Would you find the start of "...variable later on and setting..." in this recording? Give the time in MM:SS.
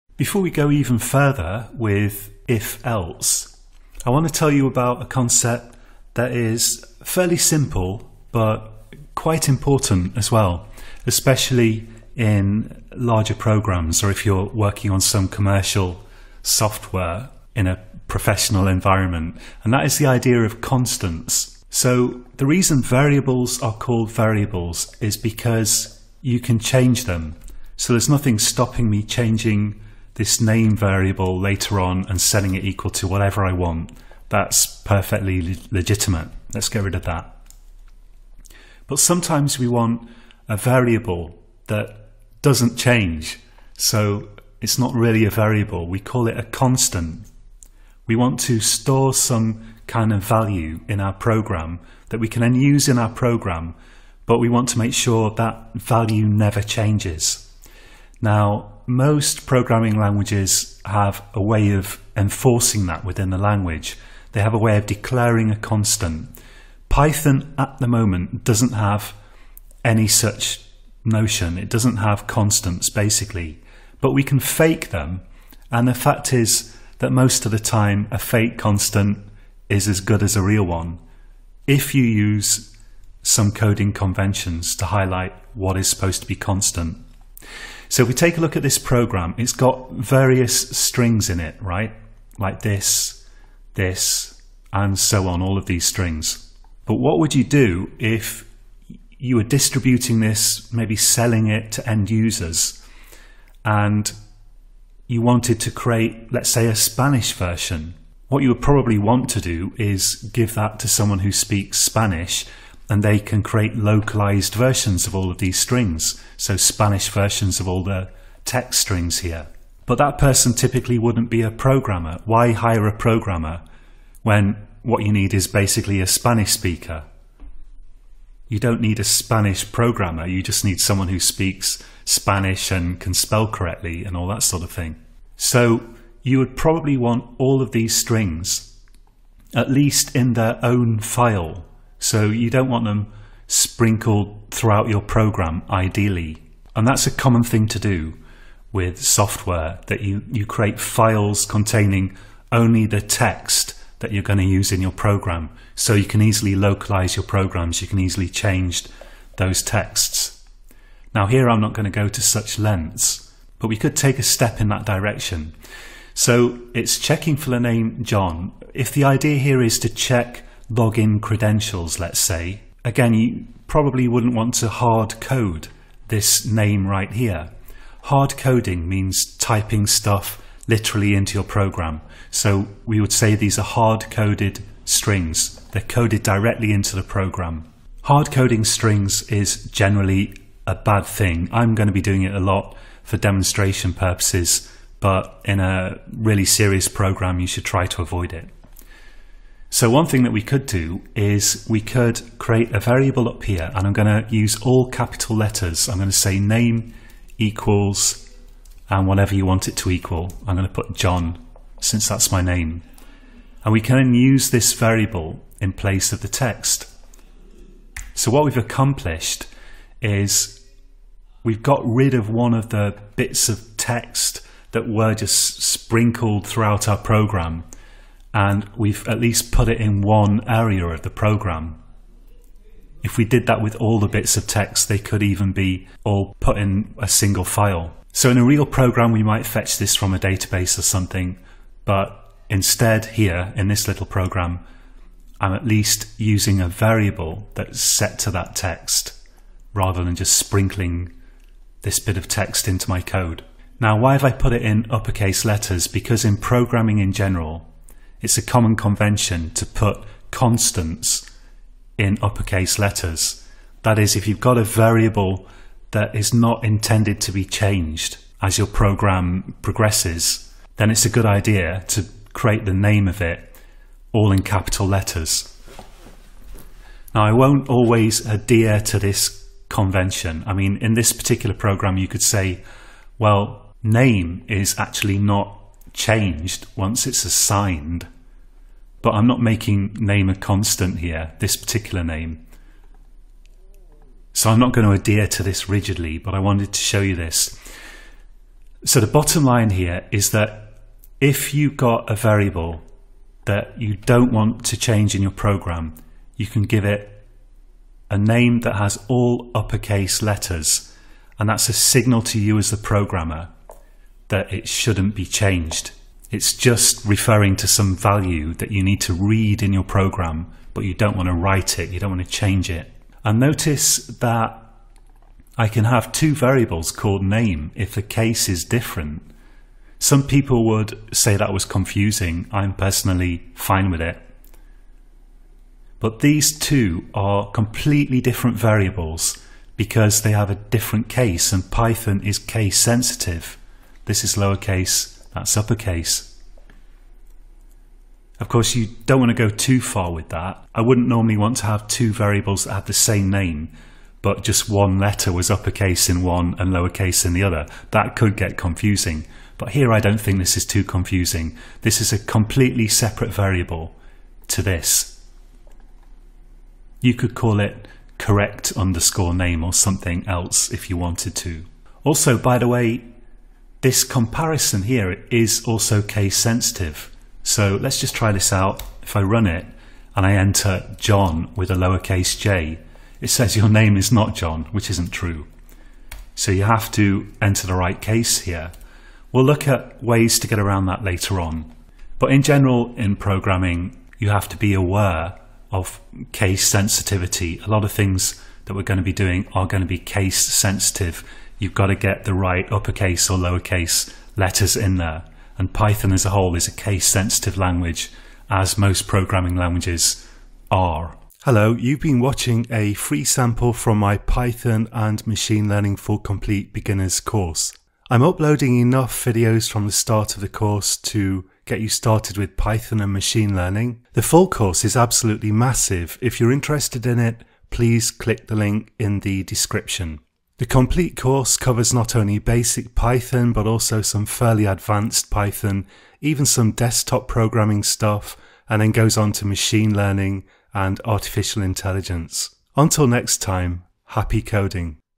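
00:30.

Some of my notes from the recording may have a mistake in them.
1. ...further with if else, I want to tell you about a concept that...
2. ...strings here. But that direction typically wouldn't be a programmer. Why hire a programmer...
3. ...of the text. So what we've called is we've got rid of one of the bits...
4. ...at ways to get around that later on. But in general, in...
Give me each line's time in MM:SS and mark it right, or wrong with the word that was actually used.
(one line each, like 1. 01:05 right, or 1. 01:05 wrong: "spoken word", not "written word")
1. 00:00 right
2. 01:58 wrong: "person", not "direction"
3. 03:36 wrong: "accomplished", not "called"
4. 06:29 right.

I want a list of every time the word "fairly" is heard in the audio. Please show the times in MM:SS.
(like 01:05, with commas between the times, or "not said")
00:07, 07:14.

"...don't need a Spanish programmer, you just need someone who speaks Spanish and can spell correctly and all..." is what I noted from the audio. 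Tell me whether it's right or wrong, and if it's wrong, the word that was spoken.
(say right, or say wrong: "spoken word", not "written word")
right.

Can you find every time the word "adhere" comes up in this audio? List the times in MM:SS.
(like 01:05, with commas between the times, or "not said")
04:38, 04:54.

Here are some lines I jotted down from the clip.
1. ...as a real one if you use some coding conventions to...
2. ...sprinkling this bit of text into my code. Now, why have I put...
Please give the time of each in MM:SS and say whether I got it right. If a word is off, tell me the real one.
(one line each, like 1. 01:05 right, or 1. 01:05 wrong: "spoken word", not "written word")
1. 01:20 right
2. 04:10 right.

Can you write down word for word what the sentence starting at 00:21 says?
So the reason variables are called variables is because you can change them.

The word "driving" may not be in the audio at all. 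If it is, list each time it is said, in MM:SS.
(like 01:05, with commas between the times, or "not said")
not said.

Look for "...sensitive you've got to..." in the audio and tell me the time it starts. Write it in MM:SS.
06:40.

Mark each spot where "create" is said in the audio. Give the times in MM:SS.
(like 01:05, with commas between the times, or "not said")
01:45, 01:53, 02:30, 03:22, 04:32.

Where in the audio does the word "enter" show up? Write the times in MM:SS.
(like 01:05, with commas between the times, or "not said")
06:20, 06:27.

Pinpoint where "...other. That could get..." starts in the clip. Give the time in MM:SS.
05:57.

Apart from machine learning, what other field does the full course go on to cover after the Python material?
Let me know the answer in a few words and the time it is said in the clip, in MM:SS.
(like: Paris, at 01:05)
Artificial intelligence, at 07:21.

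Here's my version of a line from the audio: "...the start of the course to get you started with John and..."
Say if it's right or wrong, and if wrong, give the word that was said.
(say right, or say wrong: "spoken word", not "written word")
wrong: "Python", not "John".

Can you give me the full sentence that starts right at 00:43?
So it's not really a variable.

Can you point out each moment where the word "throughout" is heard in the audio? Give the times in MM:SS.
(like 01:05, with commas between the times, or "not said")
02:24, 03:46.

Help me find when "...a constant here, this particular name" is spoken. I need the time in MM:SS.
04:50.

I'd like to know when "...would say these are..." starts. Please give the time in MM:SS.
03:03.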